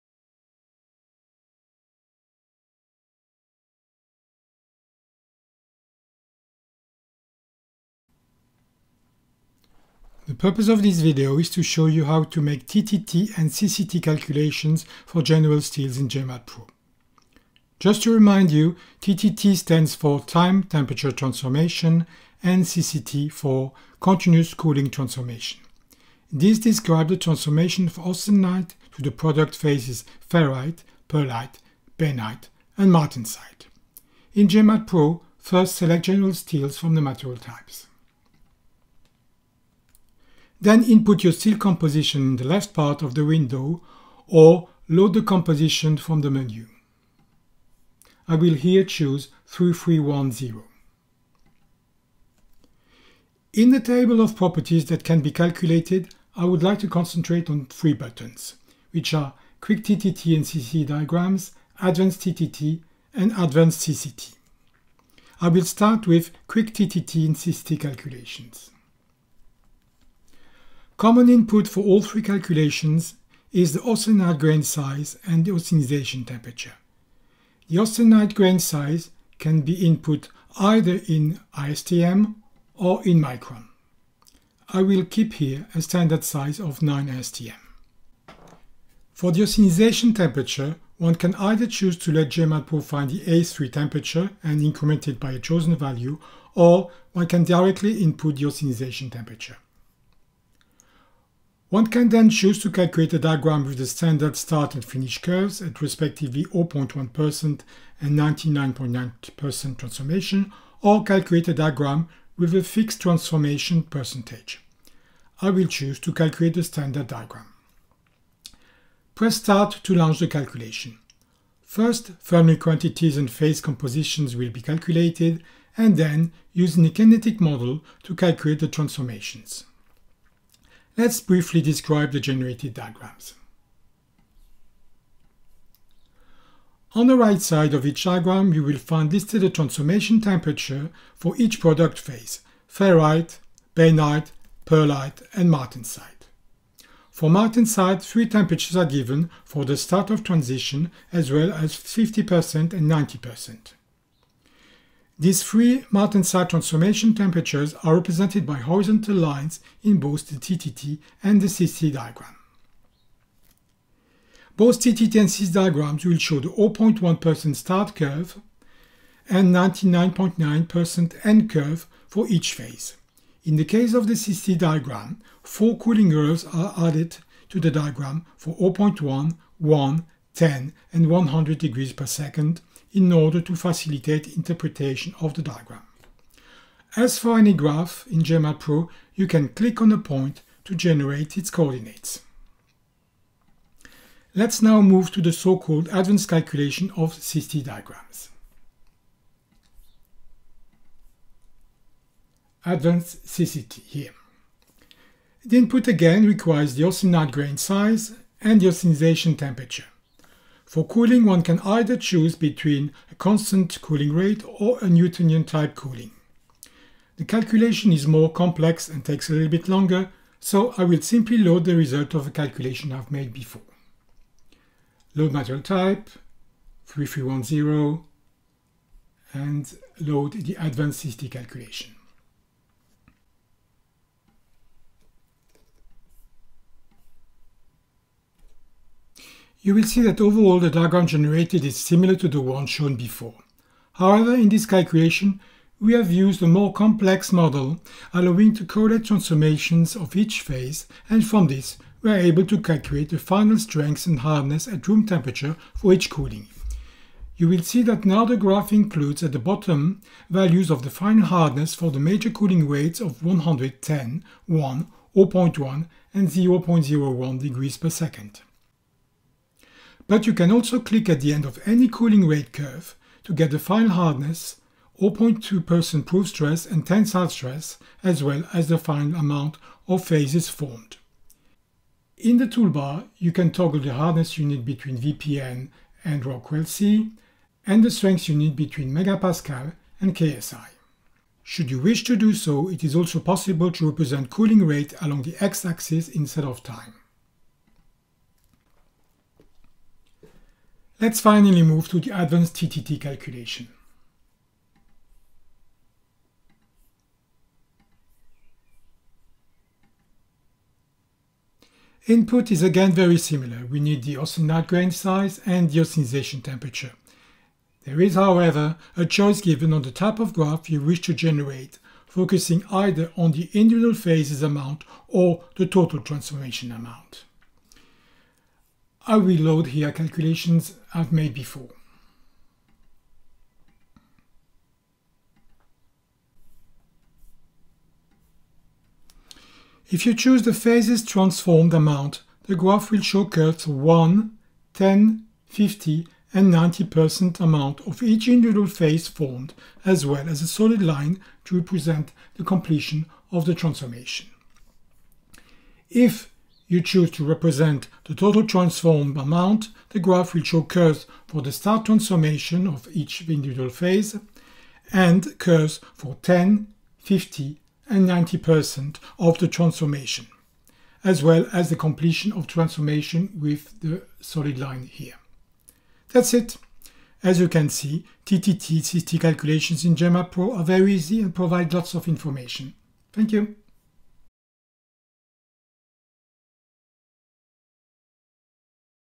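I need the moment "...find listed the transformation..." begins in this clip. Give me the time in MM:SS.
02:18.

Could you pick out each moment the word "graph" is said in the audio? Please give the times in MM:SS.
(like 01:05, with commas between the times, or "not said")
03:07, 04:18, 05:20, 05:42, 05:59.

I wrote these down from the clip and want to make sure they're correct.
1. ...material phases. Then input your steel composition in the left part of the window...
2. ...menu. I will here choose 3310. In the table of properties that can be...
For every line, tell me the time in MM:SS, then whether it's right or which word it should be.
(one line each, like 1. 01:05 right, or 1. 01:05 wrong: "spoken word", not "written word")
1. 00:37 wrong: "types", not "phases"
2. 00:46 right.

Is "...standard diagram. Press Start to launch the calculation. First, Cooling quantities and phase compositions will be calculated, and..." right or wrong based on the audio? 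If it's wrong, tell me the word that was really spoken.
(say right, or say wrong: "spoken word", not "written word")
wrong: "Fermi", not "Cooling".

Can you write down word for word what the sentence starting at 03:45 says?
Load material type, 3310, and load the advanced CCT calculation.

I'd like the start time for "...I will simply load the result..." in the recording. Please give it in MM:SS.
03:40.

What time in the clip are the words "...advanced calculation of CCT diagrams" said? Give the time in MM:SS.
03:15.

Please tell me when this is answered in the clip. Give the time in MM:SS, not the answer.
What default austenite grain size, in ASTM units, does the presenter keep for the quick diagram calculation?
01:26.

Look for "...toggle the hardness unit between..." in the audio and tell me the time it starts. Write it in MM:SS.
04:43.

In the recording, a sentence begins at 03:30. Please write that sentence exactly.
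For cooling, one can either choose between a constant cooling rate or a Newtonian type cooling.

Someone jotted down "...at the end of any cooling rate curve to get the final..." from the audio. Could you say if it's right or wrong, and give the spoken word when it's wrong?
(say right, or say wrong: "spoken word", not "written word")
right.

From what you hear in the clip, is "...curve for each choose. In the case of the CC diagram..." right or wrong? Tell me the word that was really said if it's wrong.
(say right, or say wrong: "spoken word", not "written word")
wrong: "phase", not "choose".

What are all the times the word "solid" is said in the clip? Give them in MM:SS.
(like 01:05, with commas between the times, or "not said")
05:50, 06:14.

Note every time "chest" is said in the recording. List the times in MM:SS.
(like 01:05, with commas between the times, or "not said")
not said.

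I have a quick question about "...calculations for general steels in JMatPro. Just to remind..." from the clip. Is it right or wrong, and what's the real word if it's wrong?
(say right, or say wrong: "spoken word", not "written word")
right.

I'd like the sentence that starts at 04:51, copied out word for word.
Should you wish to do so, it is also possible to represent cooling rate along the x-axis instead of time.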